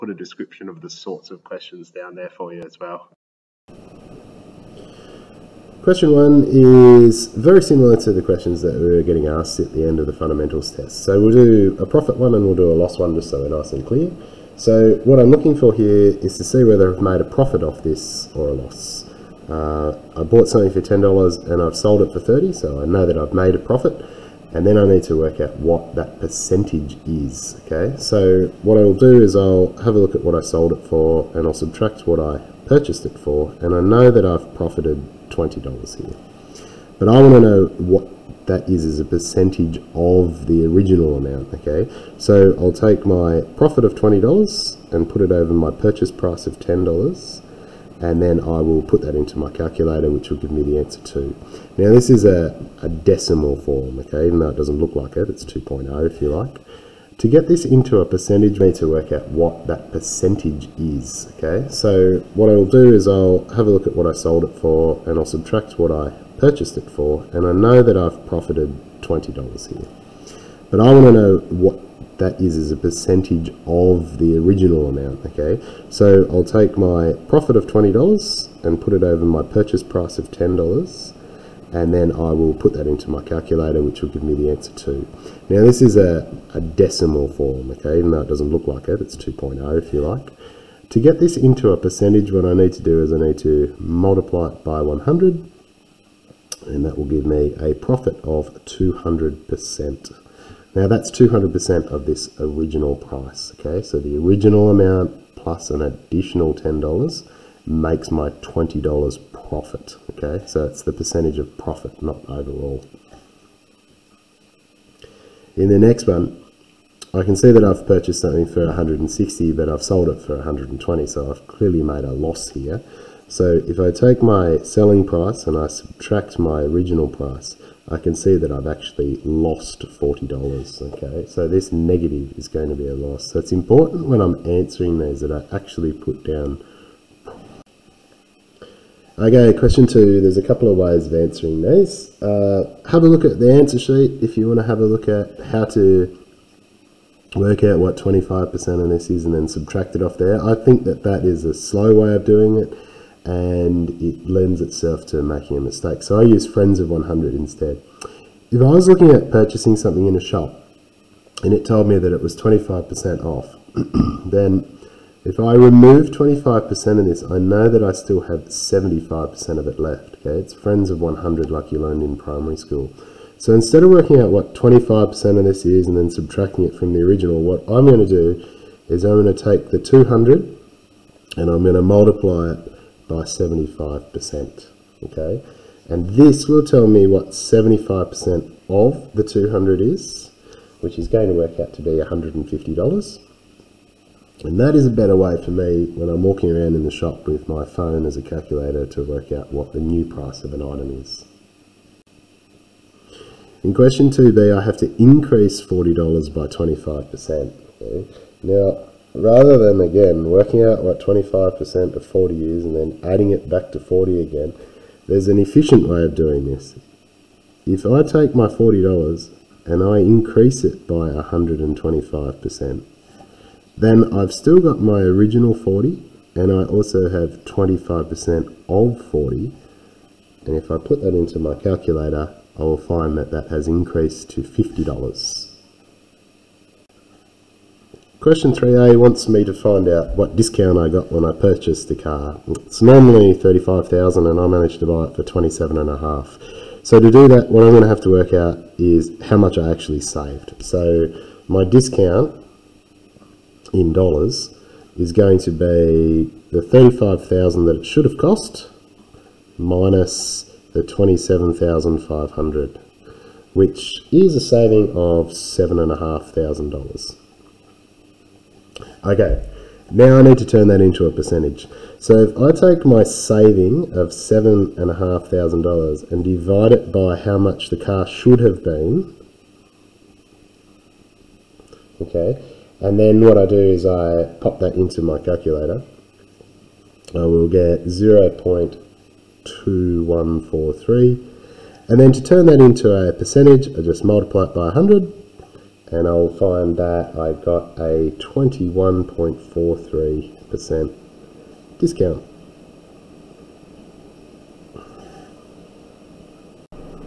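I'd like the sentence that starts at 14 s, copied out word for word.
So what I'm looking for here is to see whether I've made a profit off this or a loss.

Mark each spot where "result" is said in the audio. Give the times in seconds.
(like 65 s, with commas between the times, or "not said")
not said.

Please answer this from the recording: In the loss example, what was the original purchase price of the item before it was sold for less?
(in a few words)
160.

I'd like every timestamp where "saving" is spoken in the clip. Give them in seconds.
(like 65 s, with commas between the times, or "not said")
264 s, 273 s.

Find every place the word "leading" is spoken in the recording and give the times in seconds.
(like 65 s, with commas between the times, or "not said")
not said.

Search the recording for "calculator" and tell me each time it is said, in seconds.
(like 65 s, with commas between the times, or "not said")
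49 s, 83 s, 198 s, 231 s, 285 s.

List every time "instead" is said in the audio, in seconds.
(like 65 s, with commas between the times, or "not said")
157 s, 173 s.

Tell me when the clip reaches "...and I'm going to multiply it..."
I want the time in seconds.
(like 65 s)
181 s.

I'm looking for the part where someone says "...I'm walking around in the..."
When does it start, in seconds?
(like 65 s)
196 s.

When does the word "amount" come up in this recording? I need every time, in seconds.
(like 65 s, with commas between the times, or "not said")
41 s, 74 s, 104 s.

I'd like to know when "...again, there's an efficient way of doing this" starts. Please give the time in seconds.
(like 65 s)
214 s.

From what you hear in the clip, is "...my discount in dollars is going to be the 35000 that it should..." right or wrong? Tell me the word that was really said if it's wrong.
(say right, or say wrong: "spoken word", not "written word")
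right.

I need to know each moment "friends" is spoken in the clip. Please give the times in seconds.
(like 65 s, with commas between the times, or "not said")
156 s, 170 s.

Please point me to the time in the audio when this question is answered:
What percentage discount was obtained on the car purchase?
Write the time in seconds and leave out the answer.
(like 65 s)
298 s.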